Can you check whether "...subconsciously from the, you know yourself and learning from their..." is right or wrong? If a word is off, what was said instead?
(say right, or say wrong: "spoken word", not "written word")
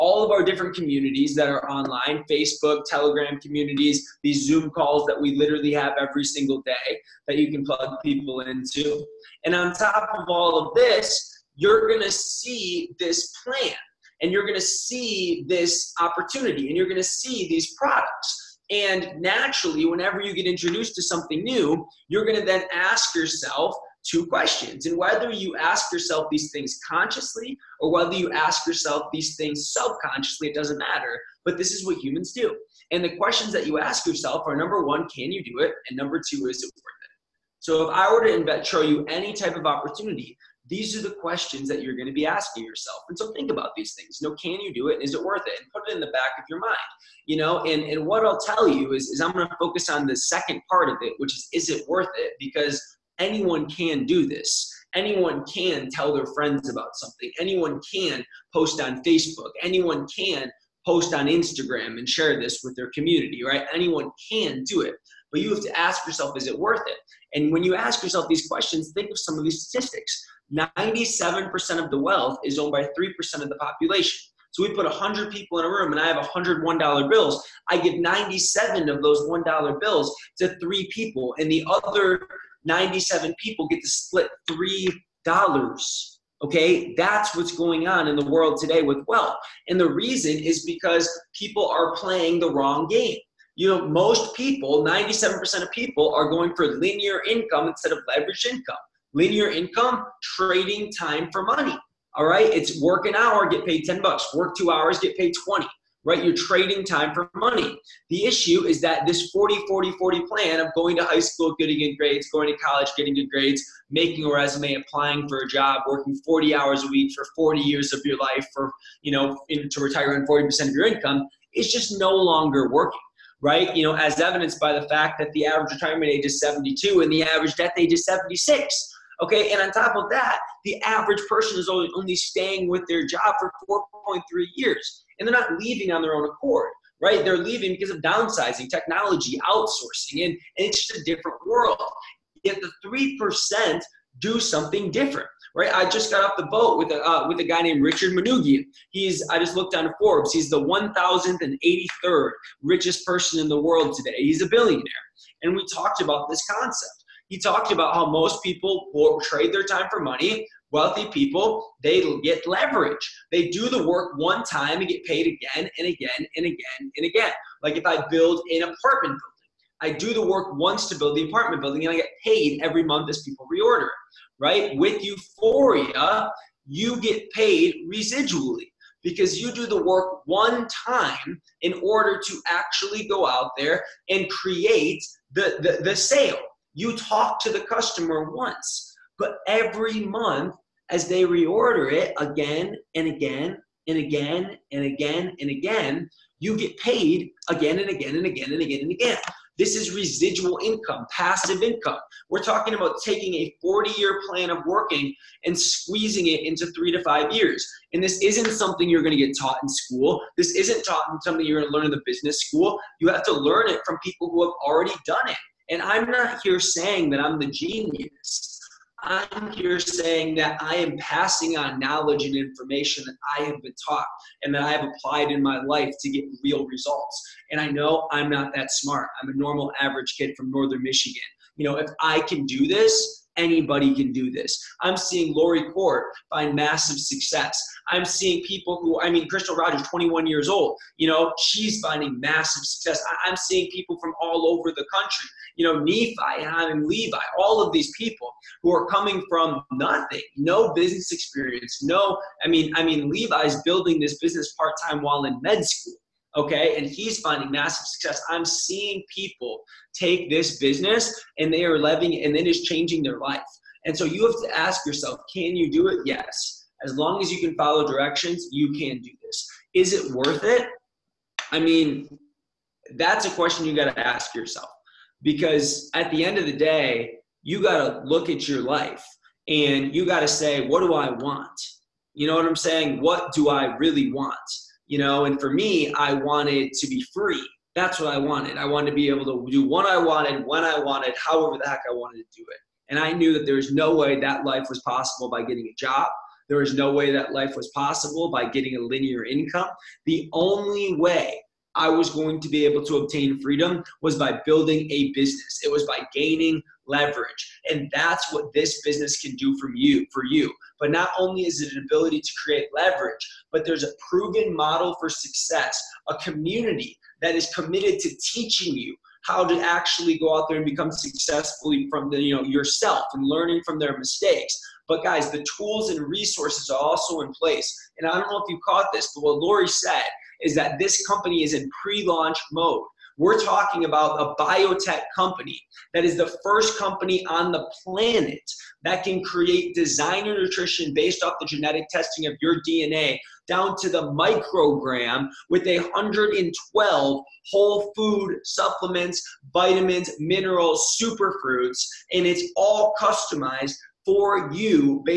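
wrong: "successfully", not "subconsciously".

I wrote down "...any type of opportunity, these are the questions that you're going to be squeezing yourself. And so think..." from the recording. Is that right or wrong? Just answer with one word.
wrong.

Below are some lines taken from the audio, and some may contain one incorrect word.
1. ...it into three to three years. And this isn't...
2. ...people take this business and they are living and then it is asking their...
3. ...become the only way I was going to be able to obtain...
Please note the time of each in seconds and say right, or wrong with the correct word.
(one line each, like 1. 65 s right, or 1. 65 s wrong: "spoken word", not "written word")
1. 206 s wrong: "five", not "three"
2. 259 s wrong: "changing", not "asking"
3. 299 s wrong: "income", not "become".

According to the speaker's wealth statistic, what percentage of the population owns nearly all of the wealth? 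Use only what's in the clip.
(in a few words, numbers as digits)
3%.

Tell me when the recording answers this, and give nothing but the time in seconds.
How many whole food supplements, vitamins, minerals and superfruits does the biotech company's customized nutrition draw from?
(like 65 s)
345 s.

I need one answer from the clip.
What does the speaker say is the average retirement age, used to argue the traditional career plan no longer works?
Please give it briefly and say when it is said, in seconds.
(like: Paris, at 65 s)
72, at 126 s.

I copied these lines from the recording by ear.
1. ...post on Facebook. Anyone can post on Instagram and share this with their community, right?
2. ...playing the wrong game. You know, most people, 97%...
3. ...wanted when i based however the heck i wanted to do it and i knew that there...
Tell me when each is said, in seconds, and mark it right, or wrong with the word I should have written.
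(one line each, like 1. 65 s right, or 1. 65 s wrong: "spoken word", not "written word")
1. 58 s right
2. 91 s right
3. 289 s wrong: "wanted", not "based".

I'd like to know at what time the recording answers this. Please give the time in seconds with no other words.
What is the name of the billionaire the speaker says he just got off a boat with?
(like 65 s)
147 s.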